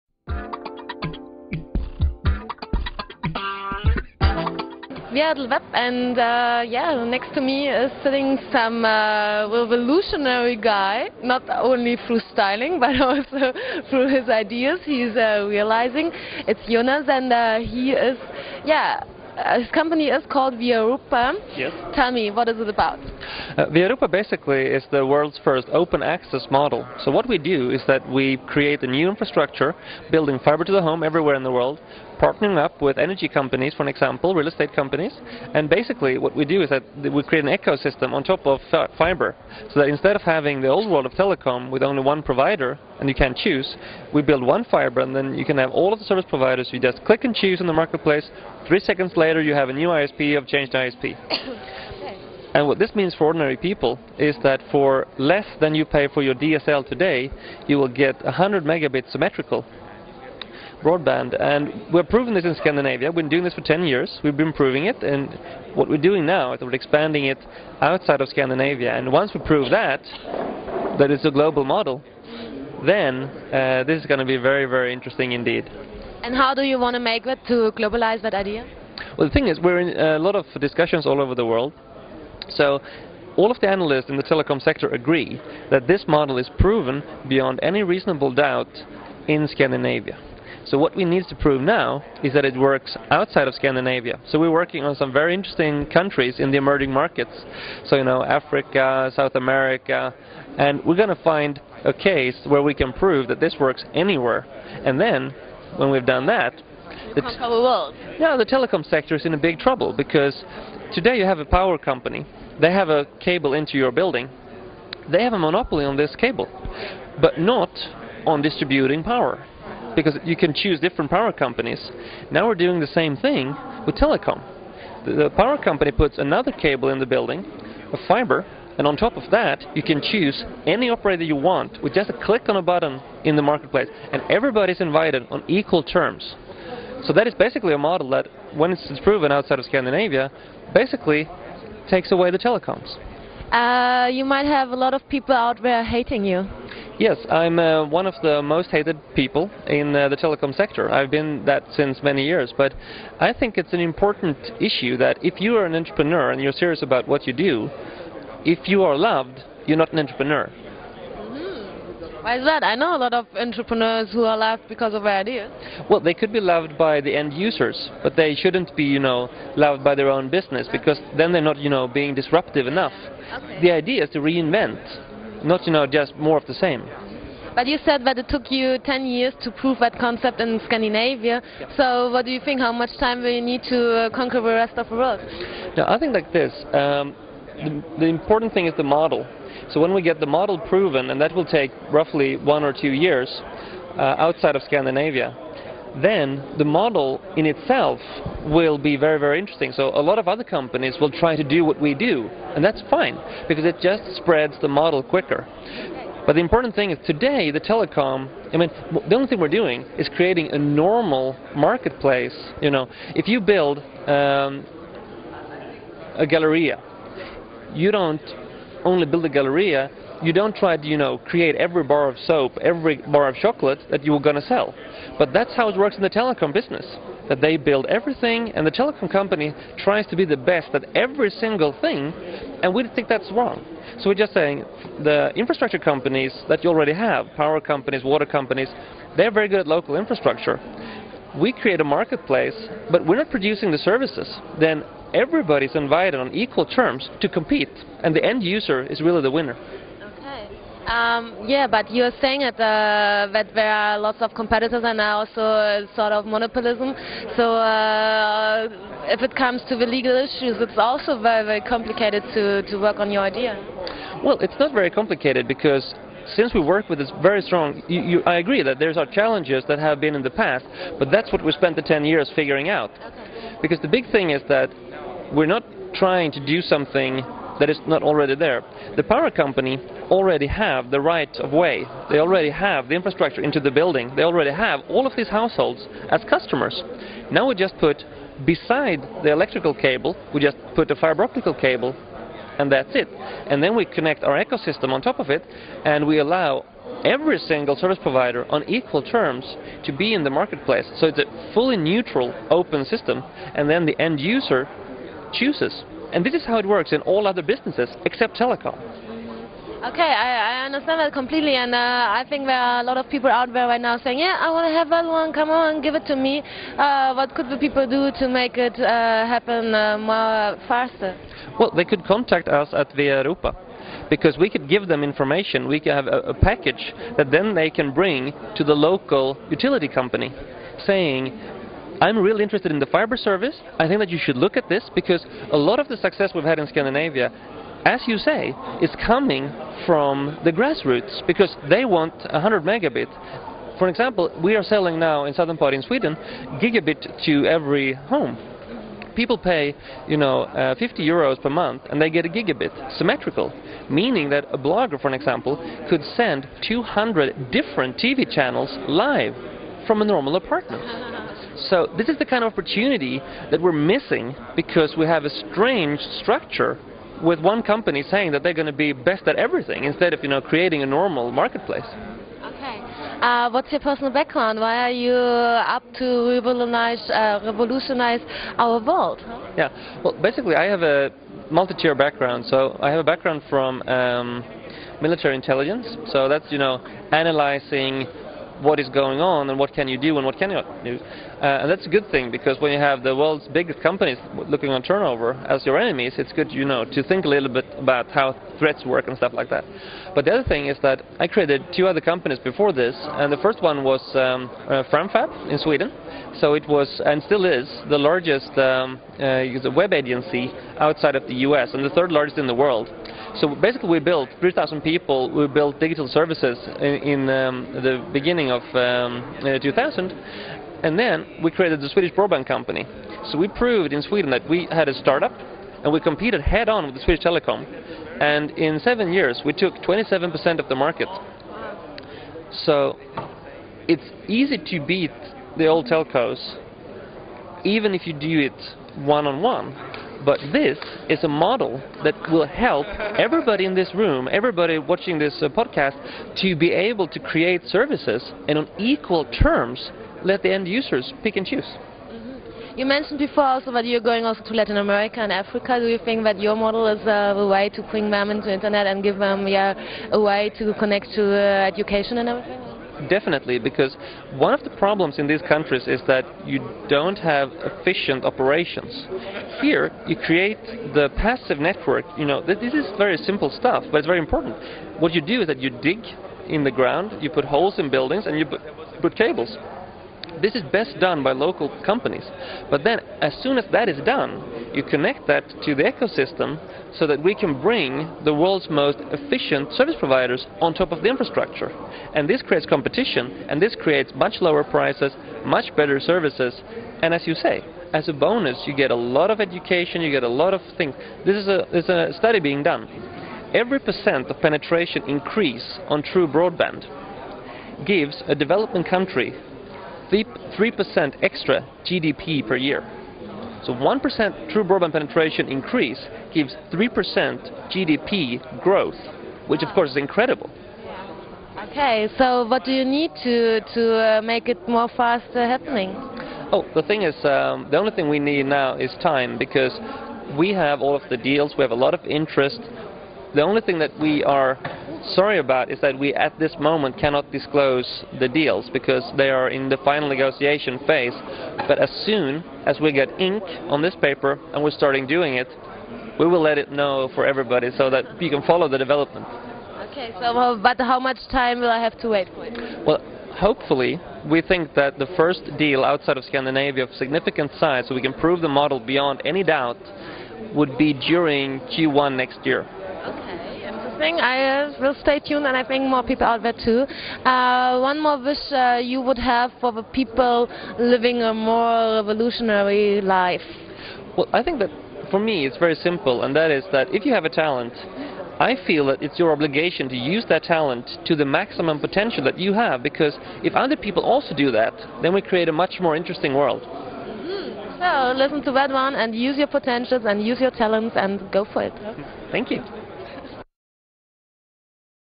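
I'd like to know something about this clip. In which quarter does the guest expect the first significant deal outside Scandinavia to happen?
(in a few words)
Q1 next year.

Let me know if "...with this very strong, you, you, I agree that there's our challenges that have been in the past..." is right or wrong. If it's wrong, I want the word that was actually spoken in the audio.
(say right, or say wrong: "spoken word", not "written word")
right.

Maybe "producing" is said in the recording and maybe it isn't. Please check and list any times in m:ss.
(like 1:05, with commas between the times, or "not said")
4:03.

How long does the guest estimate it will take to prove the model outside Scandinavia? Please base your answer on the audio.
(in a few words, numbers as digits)
1 or 2 years.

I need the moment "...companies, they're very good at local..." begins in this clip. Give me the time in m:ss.
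3:58.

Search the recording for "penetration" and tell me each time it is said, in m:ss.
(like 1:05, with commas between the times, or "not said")
8:24, 8:34.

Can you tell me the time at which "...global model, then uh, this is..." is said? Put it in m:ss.
1:11.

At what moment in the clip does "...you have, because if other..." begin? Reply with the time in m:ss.
9:42.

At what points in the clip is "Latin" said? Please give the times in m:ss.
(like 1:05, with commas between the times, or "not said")
7:34.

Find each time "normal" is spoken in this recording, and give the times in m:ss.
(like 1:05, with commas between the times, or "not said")
3:30, 6:00, 6:10.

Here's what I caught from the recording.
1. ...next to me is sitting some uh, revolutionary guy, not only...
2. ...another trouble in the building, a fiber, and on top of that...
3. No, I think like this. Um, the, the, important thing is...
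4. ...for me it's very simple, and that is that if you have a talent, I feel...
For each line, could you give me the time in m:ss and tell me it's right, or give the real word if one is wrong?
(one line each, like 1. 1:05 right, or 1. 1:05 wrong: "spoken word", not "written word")
1. 0:07 right
2. 2:06 wrong: "cable", not "trouble"
3. 3:05 right
4. 9:35 right.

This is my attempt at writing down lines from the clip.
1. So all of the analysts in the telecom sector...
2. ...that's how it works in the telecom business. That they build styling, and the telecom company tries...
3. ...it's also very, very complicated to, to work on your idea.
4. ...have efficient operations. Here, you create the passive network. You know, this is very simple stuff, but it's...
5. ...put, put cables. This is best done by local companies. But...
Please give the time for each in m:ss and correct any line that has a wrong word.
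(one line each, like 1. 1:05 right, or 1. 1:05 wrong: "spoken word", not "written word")
1. 1:22 right
2. 3:45 wrong: "everything", not "styling"
3. 4:20 right
4. 7:47 right
5. 7:58 right.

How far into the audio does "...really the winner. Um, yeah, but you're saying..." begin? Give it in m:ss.
4:08.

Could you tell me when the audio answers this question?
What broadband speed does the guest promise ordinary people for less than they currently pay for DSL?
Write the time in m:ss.
0:58.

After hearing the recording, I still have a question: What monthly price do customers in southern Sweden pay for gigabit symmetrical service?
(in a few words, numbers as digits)
50 euros.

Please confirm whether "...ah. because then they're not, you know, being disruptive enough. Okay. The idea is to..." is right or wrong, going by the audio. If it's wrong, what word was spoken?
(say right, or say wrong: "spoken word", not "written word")
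right.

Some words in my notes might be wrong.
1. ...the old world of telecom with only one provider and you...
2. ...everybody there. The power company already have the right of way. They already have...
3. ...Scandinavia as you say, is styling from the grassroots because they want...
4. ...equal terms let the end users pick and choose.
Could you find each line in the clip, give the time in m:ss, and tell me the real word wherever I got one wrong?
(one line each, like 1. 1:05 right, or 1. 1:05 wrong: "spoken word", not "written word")
1. 0:40 right
2. 4:38 wrong: "already", not "everybody"
3. 5:36 wrong: "coming", not "styling"
4. 7:28 right.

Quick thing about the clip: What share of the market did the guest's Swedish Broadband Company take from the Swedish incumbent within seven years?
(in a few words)
27%.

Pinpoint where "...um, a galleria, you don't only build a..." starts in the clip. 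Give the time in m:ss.
3:34.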